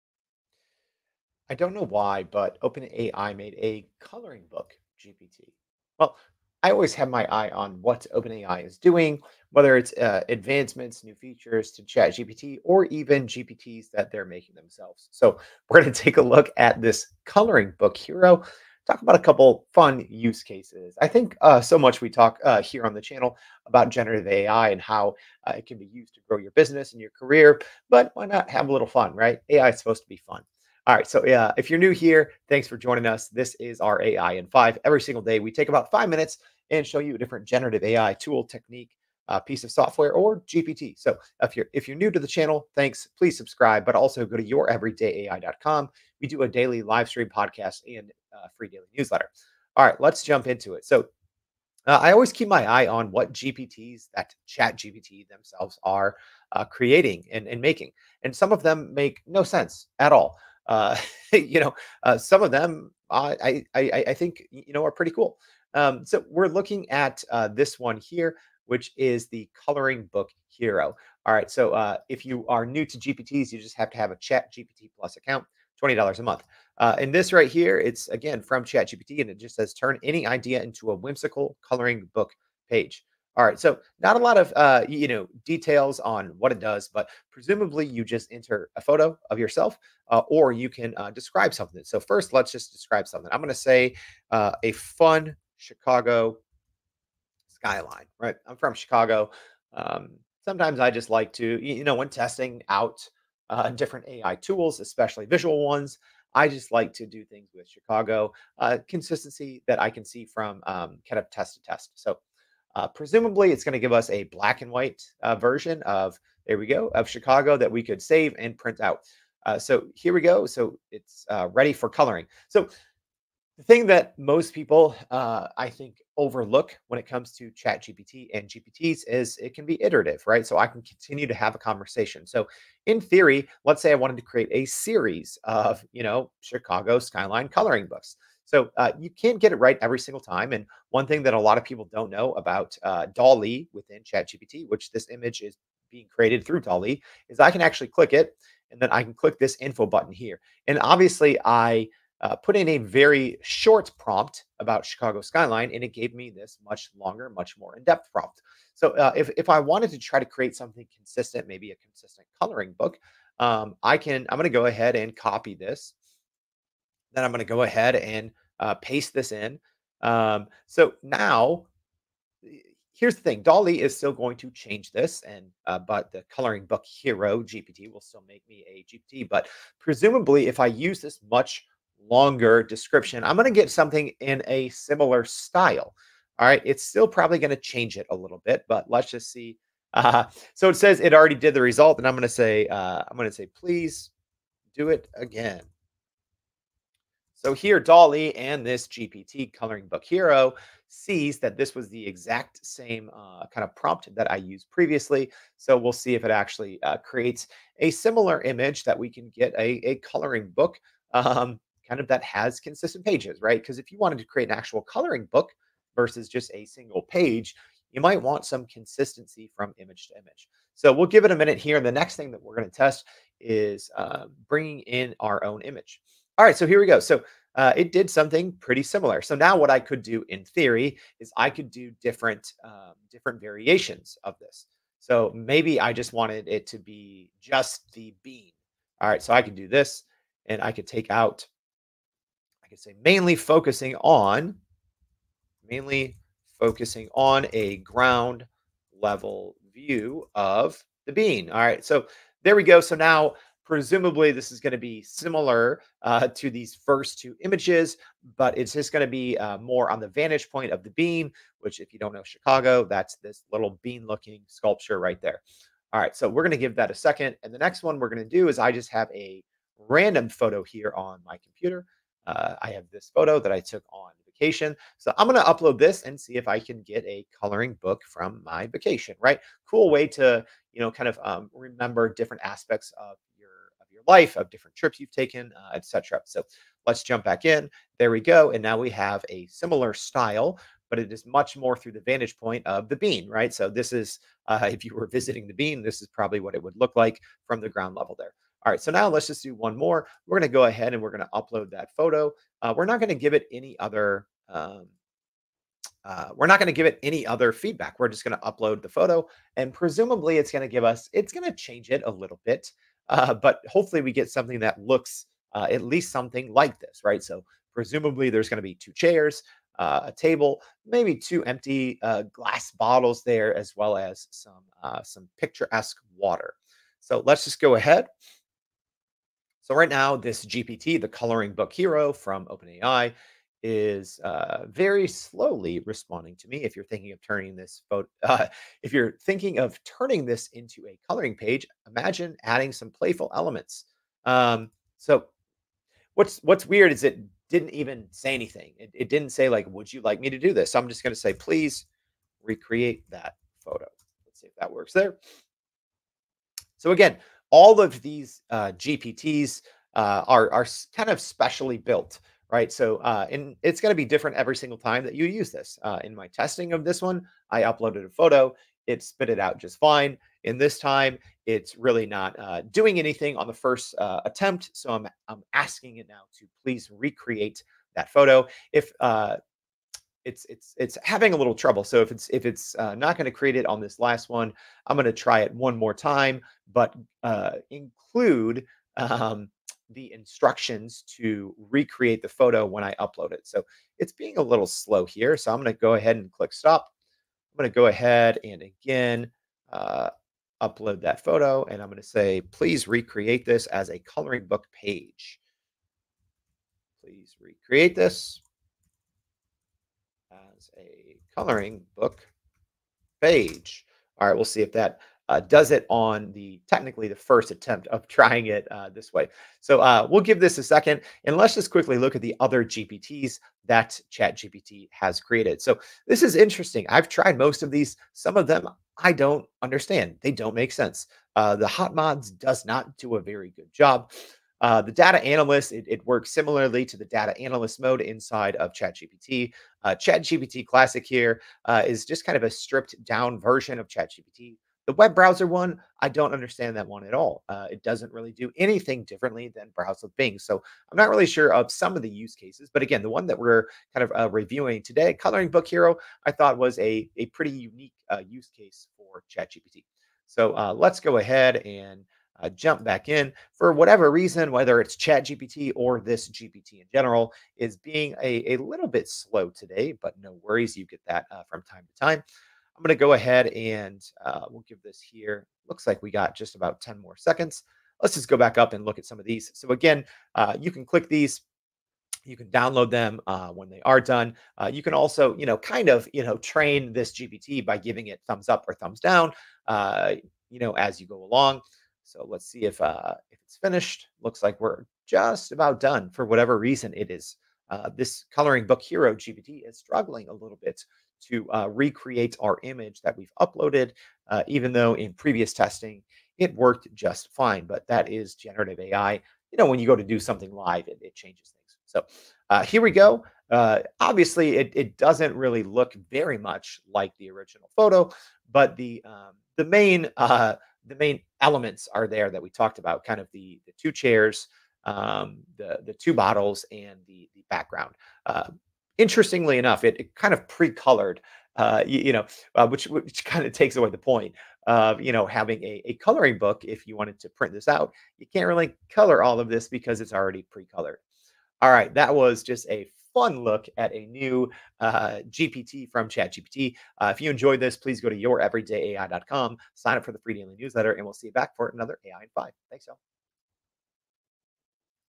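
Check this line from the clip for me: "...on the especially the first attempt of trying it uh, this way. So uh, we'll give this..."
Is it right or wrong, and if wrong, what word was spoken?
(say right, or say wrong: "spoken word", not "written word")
wrong: "technically", not "especially".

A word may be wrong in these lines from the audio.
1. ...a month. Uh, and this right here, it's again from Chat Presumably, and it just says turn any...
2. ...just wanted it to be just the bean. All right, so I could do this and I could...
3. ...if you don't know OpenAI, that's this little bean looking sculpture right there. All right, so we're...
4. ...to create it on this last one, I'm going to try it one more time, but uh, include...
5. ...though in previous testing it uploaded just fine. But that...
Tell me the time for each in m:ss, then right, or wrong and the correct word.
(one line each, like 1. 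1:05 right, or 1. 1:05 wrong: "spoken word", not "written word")
1. 1:16 wrong: "GPT", not "Presumably"
2. 3:55 right
3. 4:21 wrong: "Chicago", not "OpenAI"
4. 6:23 right
5. 8:24 wrong: "worked", not "uploaded".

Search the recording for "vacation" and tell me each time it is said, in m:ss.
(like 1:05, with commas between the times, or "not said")
4:34, 4:38.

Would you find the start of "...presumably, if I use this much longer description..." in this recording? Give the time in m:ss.
2:59.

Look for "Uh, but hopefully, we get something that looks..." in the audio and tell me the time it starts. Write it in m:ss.
5:13.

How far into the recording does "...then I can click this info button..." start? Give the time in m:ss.
2:28.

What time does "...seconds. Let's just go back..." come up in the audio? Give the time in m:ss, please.
7:57.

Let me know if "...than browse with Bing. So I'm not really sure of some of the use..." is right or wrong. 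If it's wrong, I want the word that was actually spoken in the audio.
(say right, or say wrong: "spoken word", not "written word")
right.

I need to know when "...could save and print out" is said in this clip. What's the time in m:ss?
1:57.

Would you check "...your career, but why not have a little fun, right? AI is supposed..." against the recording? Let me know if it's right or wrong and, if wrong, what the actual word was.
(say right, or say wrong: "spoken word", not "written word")
right.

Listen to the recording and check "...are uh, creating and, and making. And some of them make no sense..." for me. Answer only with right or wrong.
right.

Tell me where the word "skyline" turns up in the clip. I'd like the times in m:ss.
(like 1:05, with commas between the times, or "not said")
1:37, 2:16, 2:35.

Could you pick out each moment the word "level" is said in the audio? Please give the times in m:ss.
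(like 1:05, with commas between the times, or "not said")
4:08, 4:57.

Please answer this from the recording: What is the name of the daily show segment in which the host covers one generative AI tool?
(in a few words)
AI in 5.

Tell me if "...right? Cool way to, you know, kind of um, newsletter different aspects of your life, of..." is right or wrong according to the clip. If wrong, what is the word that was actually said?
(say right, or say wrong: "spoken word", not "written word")
wrong: "remember", not "newsletter".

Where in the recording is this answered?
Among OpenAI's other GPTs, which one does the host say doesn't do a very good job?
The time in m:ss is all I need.
7:11.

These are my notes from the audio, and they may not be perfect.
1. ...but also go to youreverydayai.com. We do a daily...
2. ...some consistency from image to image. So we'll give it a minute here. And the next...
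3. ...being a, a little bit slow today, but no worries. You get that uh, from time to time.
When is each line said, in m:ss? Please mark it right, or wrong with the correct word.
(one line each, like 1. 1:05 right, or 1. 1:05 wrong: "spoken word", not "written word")
1. 0:43 right
2. 3:38 right
3. 7:47 right.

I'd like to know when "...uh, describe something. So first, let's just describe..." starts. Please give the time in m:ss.
1:30.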